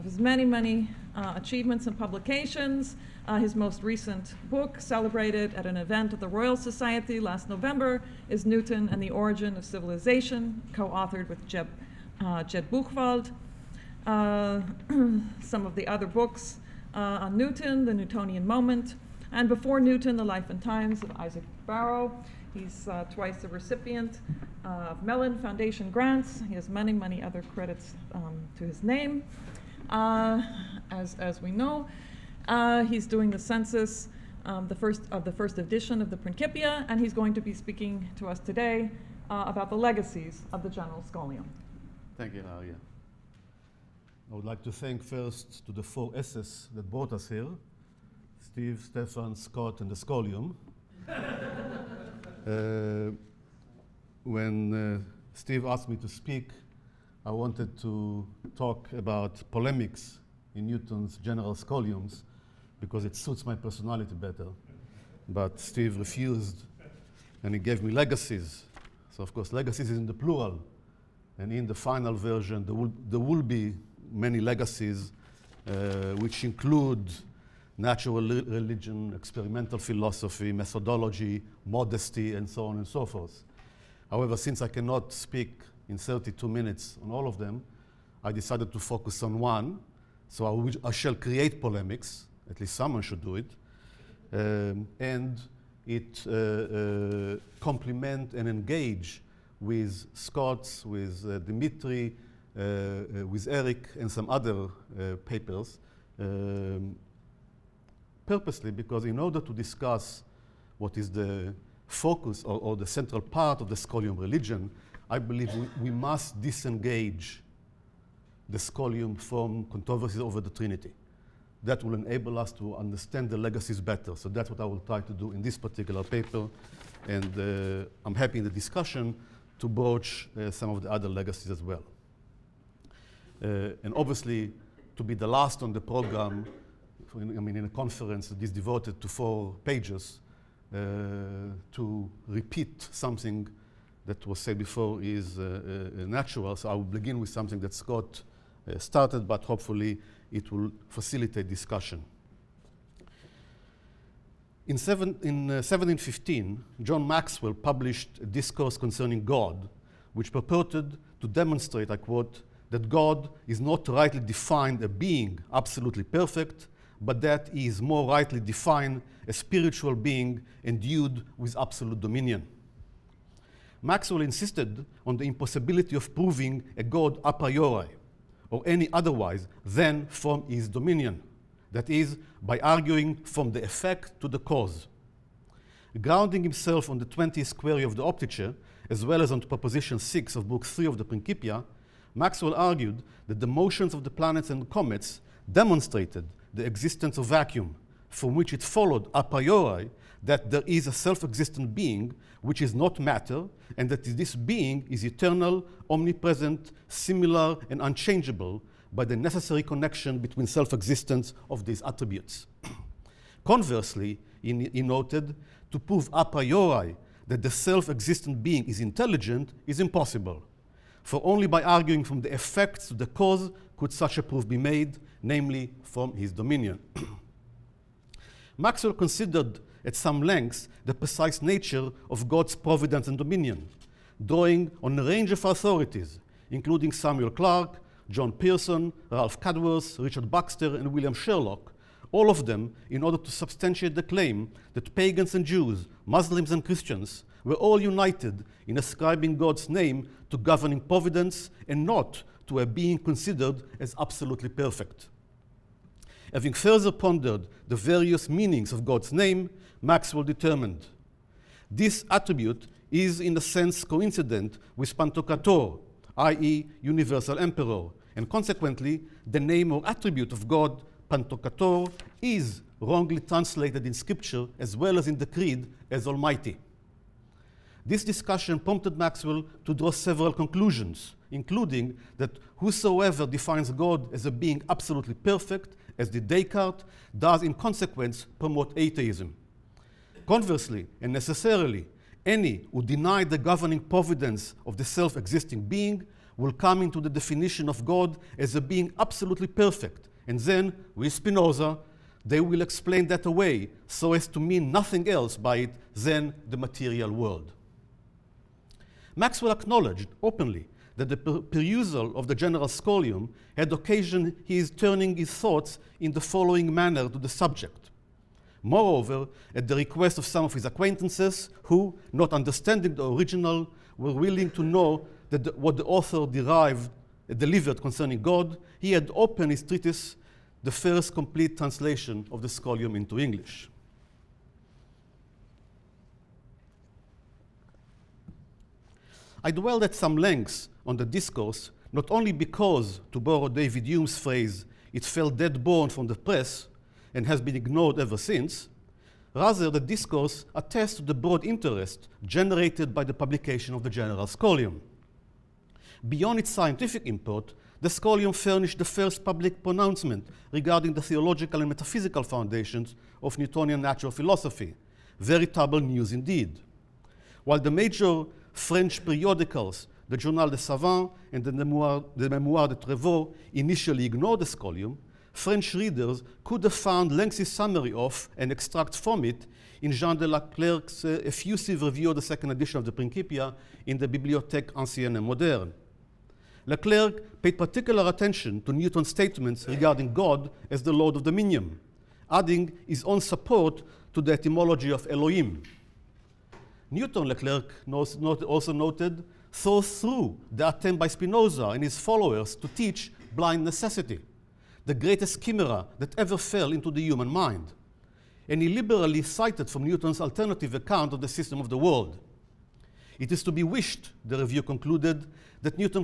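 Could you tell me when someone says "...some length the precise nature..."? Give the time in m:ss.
3:49.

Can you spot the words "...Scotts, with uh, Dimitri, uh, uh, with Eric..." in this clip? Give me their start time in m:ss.
1:40.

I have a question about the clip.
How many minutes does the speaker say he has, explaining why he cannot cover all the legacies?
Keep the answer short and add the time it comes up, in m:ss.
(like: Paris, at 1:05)
32, at 1:25.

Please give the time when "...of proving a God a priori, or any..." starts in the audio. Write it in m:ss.
2:55.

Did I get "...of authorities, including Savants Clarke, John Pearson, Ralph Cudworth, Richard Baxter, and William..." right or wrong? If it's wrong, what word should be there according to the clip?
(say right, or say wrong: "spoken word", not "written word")
wrong: "Samuel", not "Savants".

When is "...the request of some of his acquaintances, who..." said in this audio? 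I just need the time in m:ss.
5:19.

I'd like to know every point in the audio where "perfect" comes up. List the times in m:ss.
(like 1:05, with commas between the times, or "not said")
2:46, 4:14, 4:45, 4:59.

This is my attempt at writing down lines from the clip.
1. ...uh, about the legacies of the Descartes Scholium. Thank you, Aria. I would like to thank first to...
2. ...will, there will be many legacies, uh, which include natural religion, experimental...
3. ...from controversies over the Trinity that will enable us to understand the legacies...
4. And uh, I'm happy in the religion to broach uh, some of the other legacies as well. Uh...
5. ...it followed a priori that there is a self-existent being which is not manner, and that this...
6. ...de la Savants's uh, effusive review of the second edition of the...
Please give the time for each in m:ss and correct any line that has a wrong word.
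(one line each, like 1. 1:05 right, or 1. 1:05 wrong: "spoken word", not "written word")
1. 0:39 wrong: "General", not "Descartes"
2. 1:12 right
3. 1:59 right
4. 2:07 wrong: "discussion", not "religion"
5. 3:18 wrong: "matter", not "manner"
6. 6:20 wrong: "Clerc", not "Savants".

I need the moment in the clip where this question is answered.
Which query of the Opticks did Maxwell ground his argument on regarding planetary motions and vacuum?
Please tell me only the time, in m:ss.
3:07.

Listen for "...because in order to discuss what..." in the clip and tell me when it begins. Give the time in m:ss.
1:48.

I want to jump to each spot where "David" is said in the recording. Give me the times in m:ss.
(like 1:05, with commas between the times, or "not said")
5:43.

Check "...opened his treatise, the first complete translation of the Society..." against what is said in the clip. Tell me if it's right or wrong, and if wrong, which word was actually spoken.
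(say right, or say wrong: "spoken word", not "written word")
wrong: "Scholium", not "Society".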